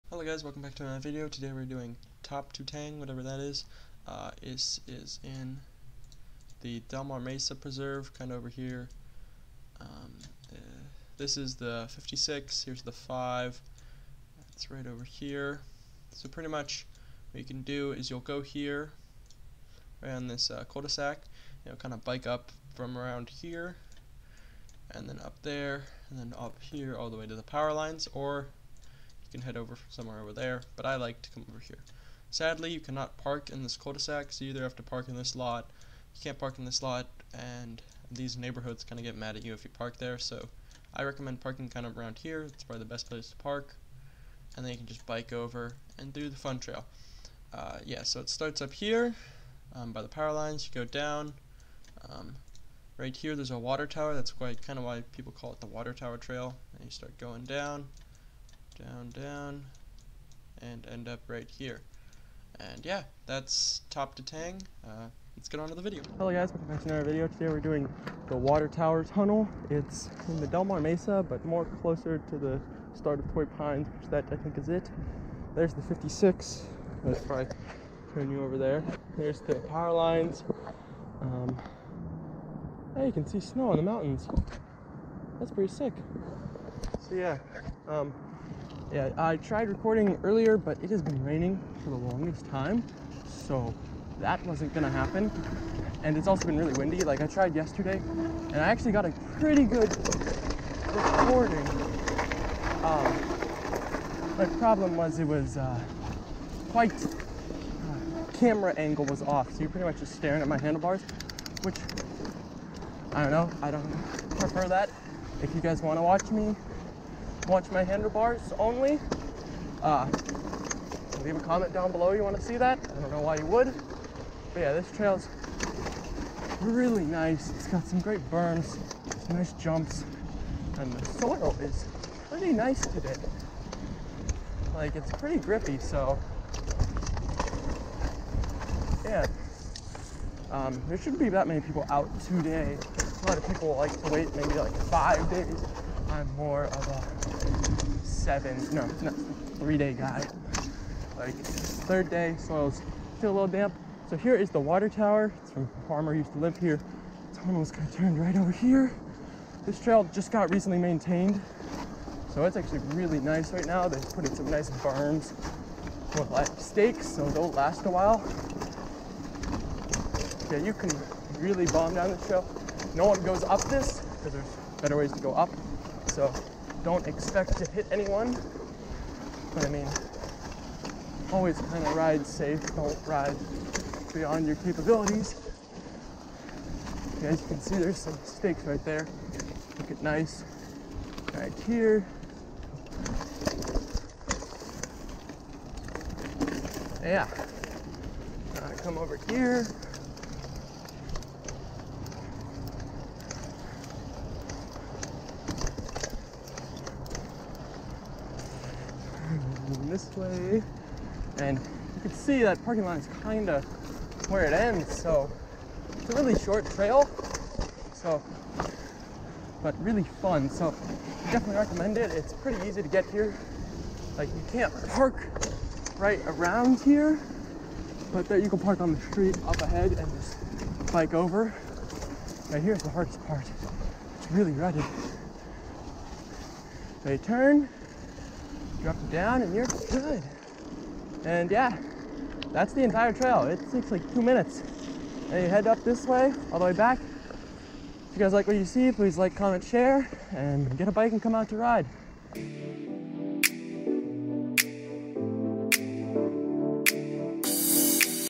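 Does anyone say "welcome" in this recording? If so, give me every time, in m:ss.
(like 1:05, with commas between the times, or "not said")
0:00, 1:06.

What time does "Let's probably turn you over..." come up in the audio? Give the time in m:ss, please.
1:17.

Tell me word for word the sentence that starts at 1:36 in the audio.
And it's also been really windy.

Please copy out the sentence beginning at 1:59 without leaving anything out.
Uh, leave a comment down below you want to see that.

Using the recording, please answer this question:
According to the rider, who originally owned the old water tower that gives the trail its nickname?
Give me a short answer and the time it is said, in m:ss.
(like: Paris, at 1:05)
a farmer, at 2:35.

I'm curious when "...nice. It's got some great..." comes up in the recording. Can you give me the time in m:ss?
2:07.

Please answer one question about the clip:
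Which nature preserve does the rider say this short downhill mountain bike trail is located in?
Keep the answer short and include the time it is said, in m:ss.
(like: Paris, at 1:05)
Del Mar Mesa Preserve, at 0:06.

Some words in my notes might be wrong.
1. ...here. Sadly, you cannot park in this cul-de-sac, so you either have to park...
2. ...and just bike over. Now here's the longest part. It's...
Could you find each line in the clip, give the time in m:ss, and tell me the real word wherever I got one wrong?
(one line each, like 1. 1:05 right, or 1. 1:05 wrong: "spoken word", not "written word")
1. 0:31 right
2. 3:49 wrong: "hardest", not "longest".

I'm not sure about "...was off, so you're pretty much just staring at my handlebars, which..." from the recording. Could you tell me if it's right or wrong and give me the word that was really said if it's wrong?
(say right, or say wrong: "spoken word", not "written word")
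right.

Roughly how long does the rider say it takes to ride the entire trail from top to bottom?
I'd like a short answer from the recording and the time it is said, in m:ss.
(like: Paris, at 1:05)
2 minutes, at 4:04.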